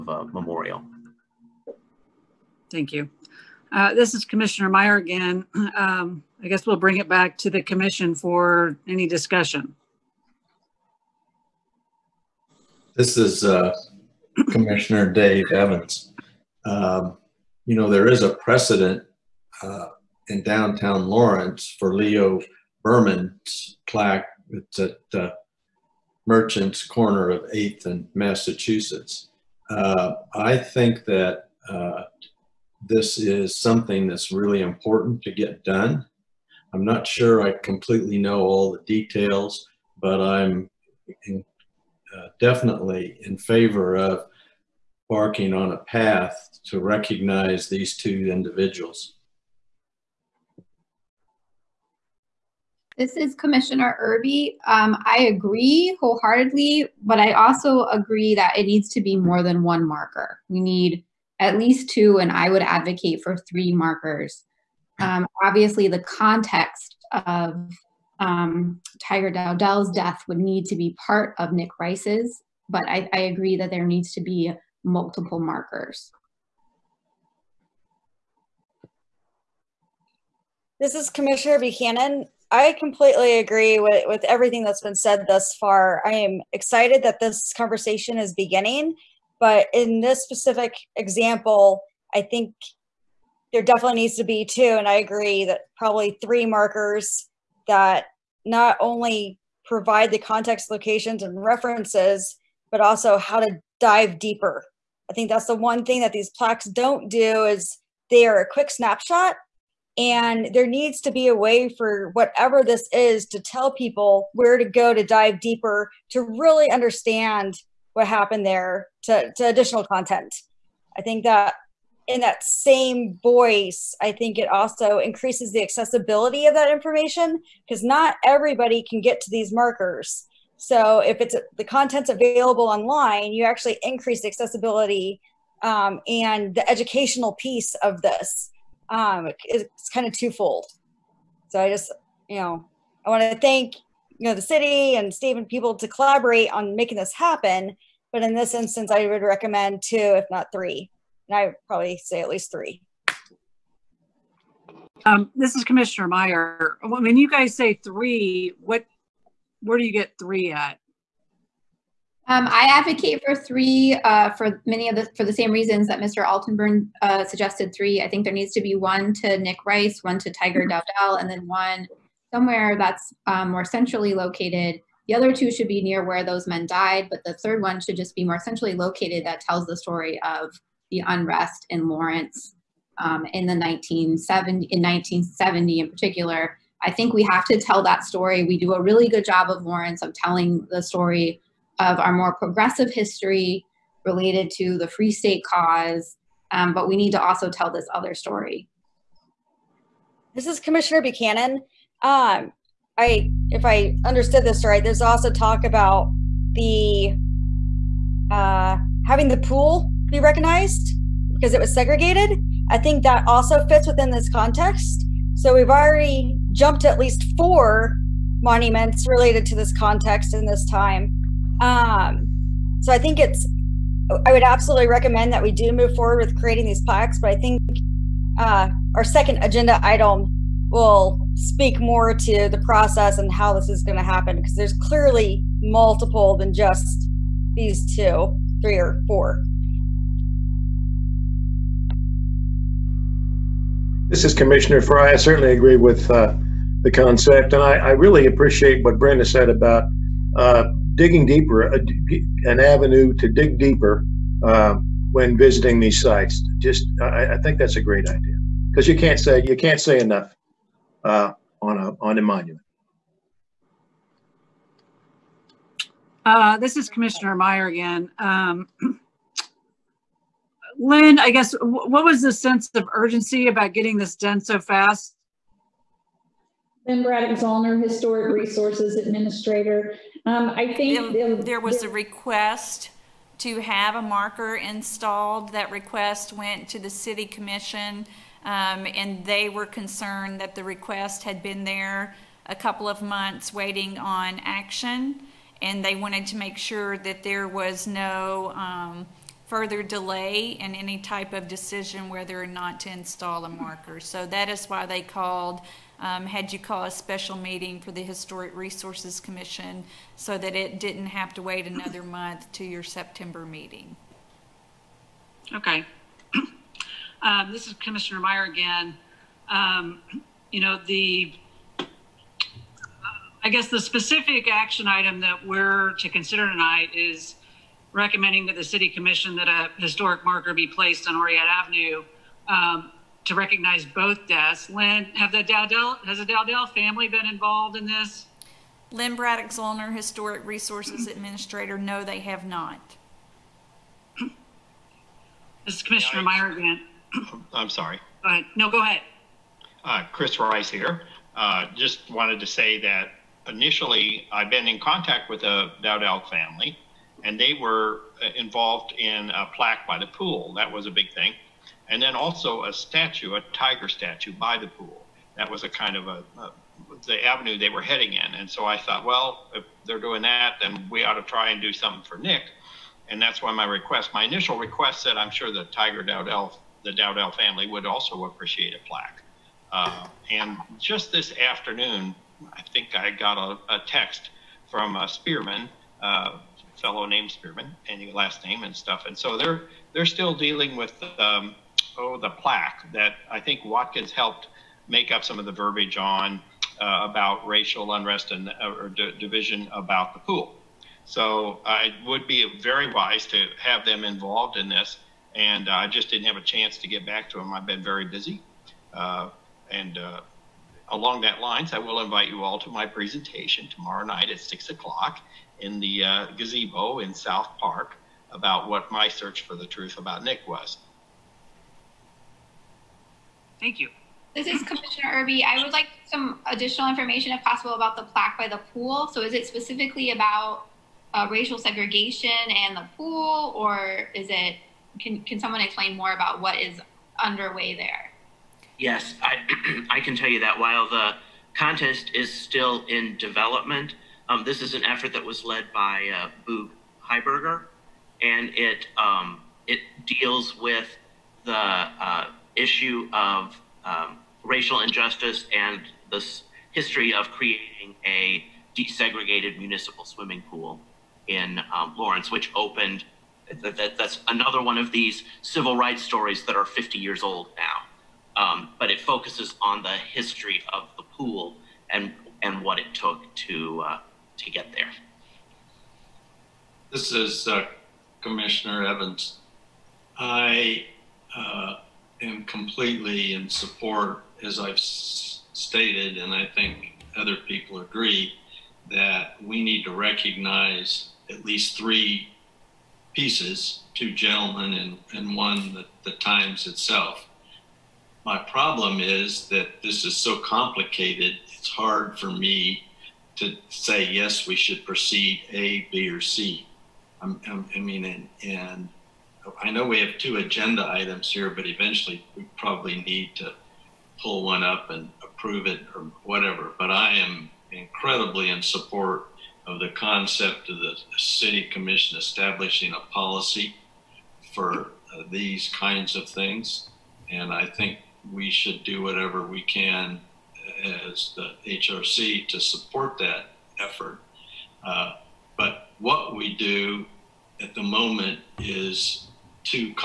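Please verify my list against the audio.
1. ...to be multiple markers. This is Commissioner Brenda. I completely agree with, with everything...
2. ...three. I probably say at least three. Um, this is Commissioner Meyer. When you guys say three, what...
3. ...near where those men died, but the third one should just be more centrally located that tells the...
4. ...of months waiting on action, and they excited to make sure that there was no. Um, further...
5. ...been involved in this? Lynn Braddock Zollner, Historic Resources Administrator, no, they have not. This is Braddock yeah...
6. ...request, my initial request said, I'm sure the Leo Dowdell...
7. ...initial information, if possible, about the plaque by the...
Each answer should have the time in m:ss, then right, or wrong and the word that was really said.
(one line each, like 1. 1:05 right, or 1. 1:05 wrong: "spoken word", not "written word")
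1. 1:14 wrong: "Buchanan", not "Brenda"
2. 2:30 right
3. 2:55 right
4. 4:52 wrong: "wanted", not "excited"
5. 5:37 wrong: "Commissioner", not "Braddock"
6. 6:13 wrong: "Tiger", not "Leo"
7. 7:06 wrong: "additional", not "initial".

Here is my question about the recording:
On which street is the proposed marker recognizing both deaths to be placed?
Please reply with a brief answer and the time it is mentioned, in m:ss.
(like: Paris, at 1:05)
Oread Avenue, at 5:31.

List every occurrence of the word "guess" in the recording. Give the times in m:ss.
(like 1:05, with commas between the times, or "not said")
0:06, 4:31, 5:23.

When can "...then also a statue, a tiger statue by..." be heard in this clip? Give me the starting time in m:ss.
6:02.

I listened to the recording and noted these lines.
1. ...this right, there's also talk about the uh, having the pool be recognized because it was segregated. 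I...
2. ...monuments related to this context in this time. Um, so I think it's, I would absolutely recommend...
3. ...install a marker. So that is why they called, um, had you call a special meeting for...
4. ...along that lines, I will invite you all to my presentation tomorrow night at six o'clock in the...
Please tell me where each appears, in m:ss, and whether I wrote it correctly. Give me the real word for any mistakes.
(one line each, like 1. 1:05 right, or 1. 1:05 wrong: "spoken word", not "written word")
1. 3:24 right
2. 3:38 right
3. 5:02 right
4. 6:50 right.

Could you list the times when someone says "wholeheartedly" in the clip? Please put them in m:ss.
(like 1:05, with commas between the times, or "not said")
0:55.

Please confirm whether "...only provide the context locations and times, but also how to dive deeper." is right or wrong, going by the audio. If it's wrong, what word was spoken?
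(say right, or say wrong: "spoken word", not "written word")
wrong: "references", not "times".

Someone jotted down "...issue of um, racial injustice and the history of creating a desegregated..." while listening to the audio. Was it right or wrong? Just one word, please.
right.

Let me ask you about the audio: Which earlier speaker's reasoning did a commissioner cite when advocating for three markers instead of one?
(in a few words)
Mr. Altenbernd.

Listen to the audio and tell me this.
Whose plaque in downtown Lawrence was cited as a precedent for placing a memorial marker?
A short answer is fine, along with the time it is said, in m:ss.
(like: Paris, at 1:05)
Leo Beuerman, at 0:21.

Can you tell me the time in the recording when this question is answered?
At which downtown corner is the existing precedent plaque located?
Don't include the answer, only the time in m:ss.
0:26.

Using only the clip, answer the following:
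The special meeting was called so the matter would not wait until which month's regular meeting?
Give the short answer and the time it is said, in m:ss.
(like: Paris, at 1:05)
September, at 5:12.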